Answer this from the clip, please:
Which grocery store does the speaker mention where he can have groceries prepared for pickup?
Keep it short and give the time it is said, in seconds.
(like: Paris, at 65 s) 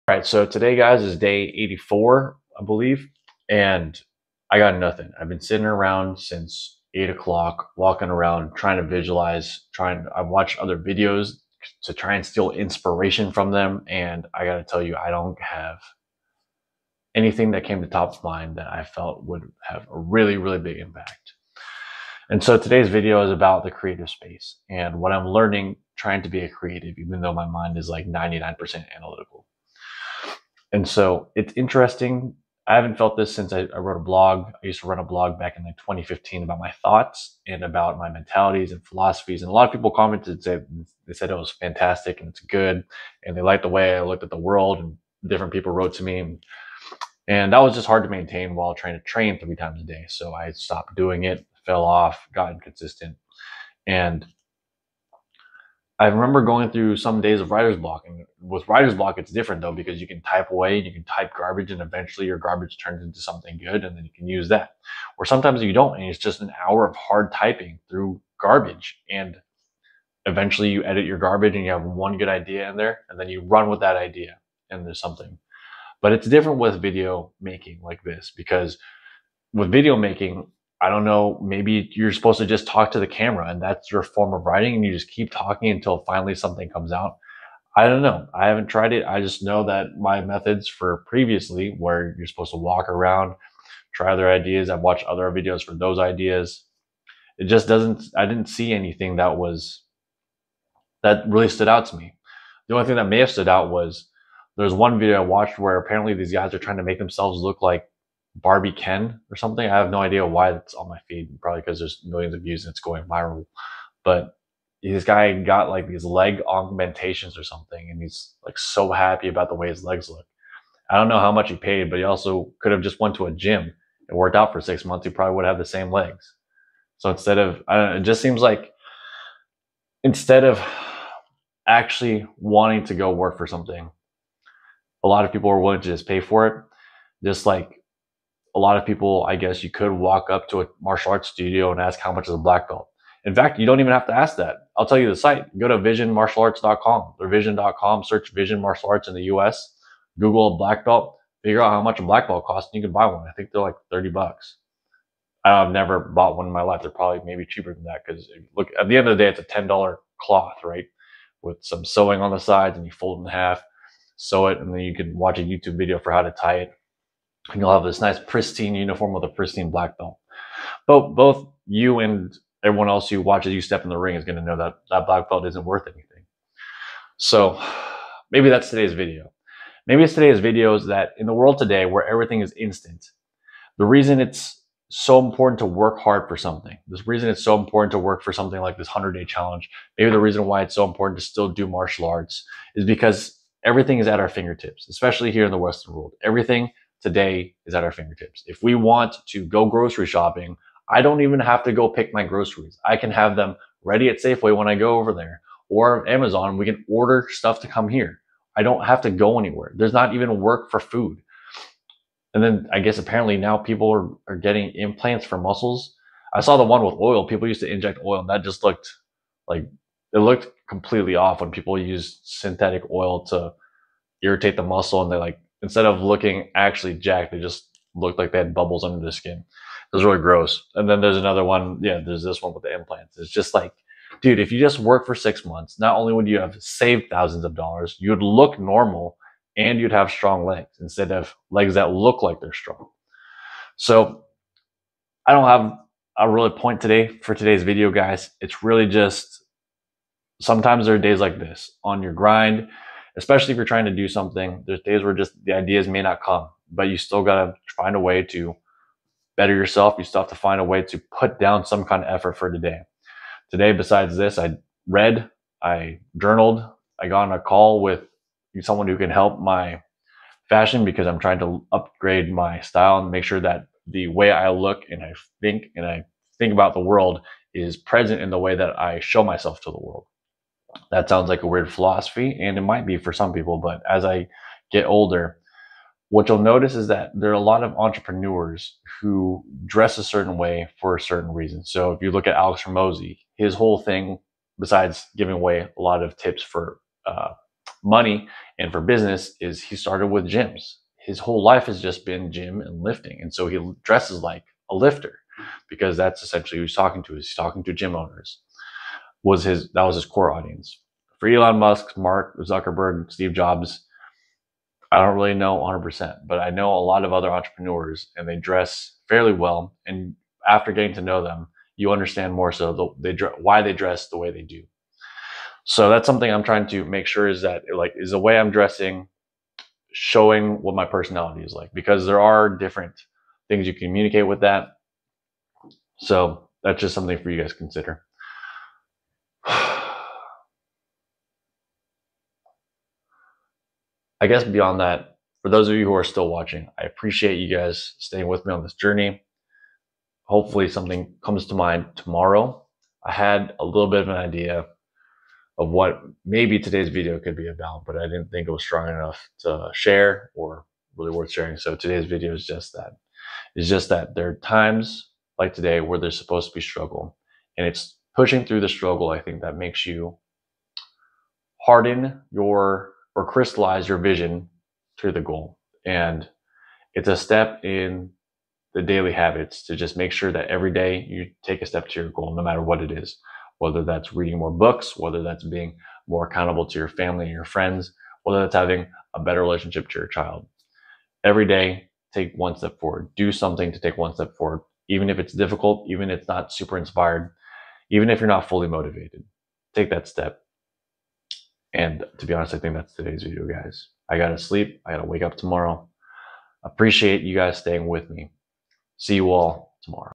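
Safeway, at 204 s.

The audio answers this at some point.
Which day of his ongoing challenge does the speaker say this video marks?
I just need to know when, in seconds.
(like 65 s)
1 s.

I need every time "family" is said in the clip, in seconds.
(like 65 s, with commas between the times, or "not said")
386 s.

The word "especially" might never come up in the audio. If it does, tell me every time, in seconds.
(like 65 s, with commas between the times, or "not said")
194 s, 253 s.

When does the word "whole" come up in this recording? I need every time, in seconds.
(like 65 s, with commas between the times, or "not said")
293 s, 301 s.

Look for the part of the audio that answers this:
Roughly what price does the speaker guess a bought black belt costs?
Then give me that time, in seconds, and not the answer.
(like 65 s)
153 s.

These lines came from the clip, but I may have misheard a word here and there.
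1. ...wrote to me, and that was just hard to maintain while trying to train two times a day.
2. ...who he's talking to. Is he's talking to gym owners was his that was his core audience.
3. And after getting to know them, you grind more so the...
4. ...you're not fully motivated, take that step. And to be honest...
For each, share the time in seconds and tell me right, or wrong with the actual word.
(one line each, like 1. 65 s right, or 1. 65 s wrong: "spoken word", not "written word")
1. 45 s wrong: "three", not "two"
2. 306 s right
3. 319 s wrong: "understand", not "grind"
4. 398 s right.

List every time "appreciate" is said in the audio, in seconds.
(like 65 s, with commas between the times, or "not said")
346 s, 406 s.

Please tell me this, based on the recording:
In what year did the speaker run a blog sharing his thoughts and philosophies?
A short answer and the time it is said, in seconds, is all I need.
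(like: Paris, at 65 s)
2015, at 35 s.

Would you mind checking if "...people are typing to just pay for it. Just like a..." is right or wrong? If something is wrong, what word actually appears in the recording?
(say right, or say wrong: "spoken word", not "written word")
wrong: "willing", not "typing".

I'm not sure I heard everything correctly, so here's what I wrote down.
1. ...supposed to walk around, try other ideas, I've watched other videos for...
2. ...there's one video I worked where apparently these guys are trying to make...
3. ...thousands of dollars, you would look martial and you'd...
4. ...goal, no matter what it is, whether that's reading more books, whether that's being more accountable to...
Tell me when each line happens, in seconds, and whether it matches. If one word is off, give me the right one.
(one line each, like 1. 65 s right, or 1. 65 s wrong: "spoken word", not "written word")
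1. 92 s right
2. 104 s wrong: "watched", not "worked"
3. 237 s wrong: "normal", not "martial"
4. 382 s right.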